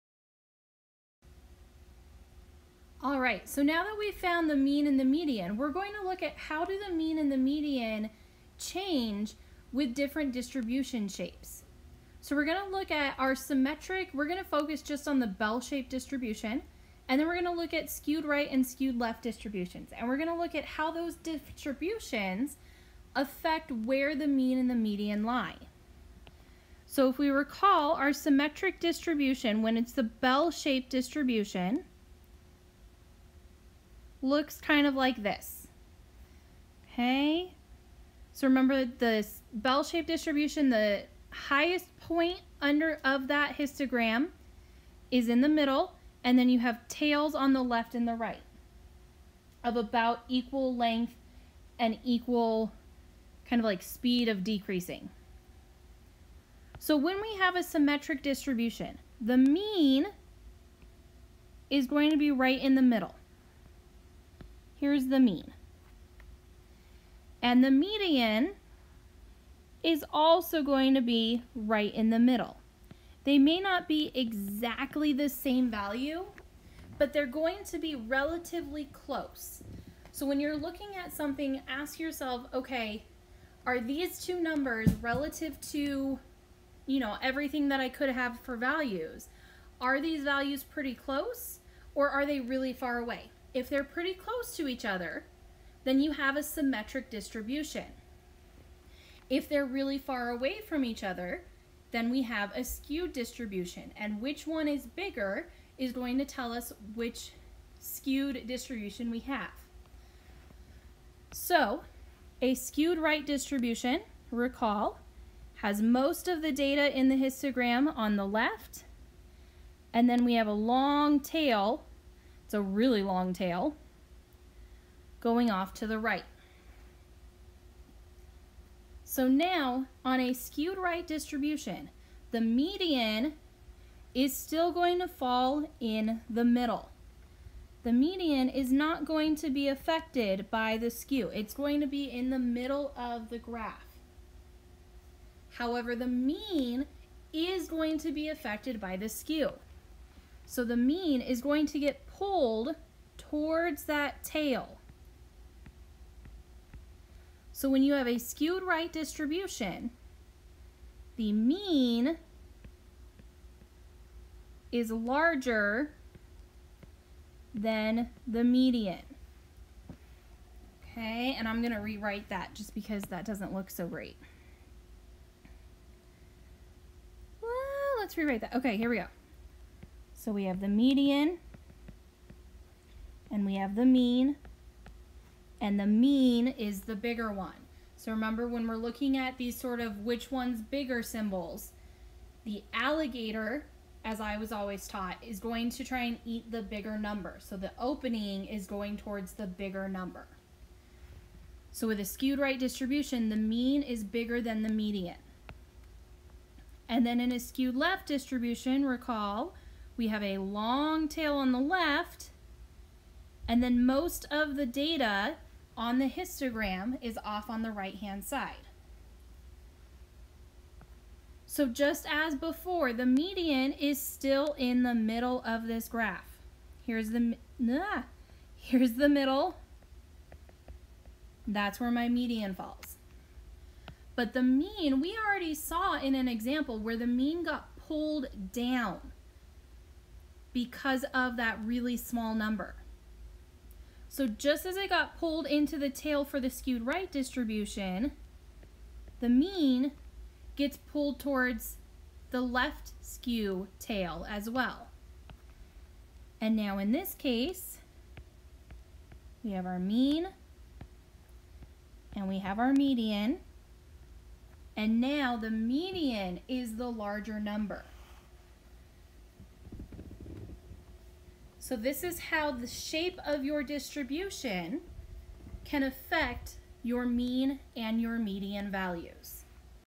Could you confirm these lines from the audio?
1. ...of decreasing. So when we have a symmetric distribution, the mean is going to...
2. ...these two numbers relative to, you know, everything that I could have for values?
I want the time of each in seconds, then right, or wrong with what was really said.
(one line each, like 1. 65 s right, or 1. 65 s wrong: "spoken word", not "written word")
1. 54 s right
2. 83 s right.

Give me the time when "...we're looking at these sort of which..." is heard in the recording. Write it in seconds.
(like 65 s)
188 s.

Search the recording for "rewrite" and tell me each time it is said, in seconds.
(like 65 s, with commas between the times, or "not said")
171 s, 178 s.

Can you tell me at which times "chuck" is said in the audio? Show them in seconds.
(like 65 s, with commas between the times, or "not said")
not said.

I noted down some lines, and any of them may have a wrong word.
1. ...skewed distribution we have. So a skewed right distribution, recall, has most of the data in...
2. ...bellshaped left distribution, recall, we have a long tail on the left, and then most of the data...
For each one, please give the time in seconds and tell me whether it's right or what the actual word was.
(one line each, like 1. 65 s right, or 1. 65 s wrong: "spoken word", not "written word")
1. 107 s right
2. 207 s wrong: "skewed", not "bellshaped".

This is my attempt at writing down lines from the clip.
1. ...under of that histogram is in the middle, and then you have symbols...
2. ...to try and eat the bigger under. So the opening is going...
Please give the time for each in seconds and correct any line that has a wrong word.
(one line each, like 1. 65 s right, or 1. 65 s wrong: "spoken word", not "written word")
1. 42 s wrong: "tails", not "symbols"
2. 195 s wrong: "number", not "under".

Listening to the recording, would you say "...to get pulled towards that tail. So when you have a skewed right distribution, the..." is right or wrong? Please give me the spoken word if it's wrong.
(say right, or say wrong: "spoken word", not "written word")
right.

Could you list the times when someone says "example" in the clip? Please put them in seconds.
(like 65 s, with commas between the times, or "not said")
236 s.